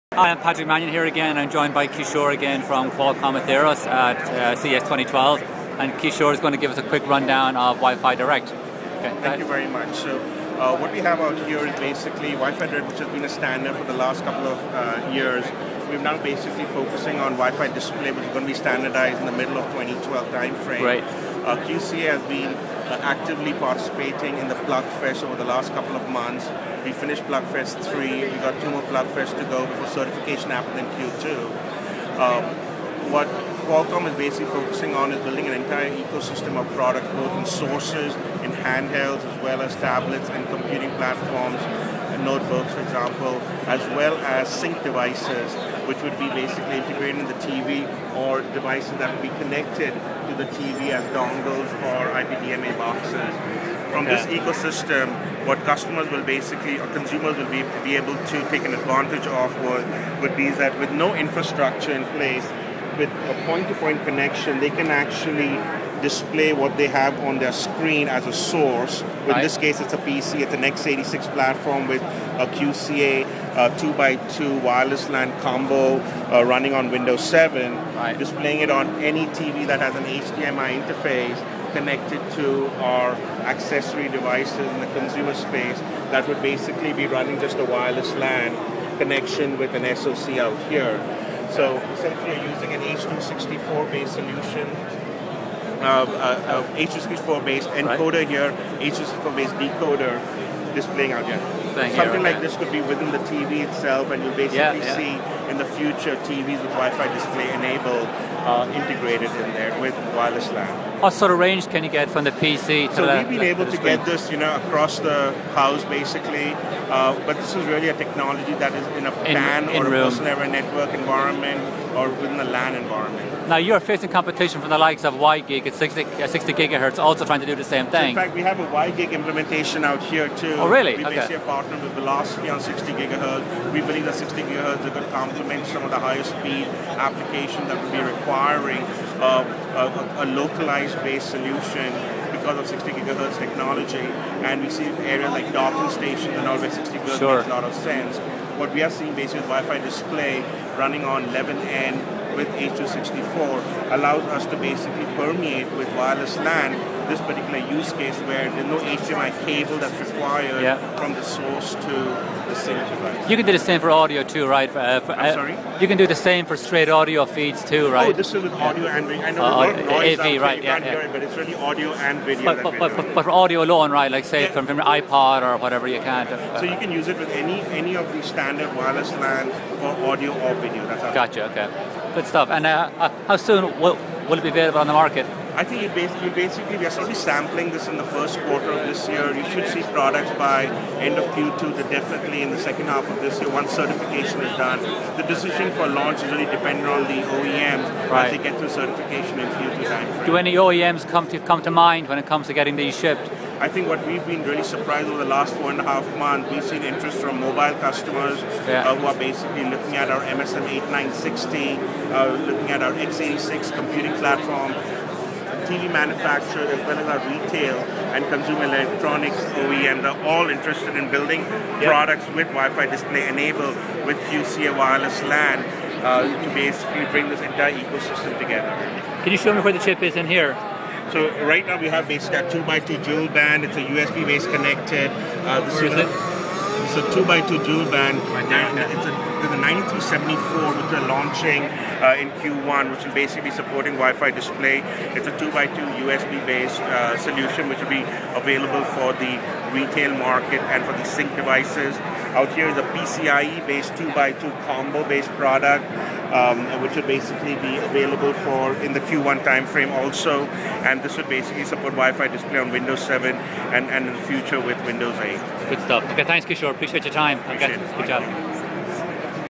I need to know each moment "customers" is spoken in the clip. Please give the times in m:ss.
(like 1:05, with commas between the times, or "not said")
0:55, 3:27.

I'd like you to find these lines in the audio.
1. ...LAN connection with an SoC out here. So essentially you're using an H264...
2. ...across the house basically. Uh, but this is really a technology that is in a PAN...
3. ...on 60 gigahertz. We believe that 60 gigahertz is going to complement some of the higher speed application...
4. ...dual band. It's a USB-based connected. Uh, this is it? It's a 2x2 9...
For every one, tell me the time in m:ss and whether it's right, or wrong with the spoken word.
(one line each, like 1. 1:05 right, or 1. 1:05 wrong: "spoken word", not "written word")
1. 1:28 right
2. 1:54 right
3. 2:12 right
4. 3:53 wrong: "2", not "9".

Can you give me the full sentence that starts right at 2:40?
from the source to the single device.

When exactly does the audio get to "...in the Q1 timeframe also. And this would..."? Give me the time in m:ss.
4:18.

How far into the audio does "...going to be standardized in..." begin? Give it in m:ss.
0:18.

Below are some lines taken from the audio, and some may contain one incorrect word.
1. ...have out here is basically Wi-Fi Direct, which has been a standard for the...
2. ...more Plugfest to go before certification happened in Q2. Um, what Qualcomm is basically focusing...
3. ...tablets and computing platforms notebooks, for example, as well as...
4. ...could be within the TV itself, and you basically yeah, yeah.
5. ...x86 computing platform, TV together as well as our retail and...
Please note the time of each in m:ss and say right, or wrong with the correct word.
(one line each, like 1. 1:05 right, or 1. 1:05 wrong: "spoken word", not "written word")
1. 0:10 right
2. 0:28 right
3. 0:39 right
4. 1:42 right
5. 3:32 wrong: "manufacturer", not "together".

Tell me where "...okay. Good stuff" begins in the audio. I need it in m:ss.
3:01.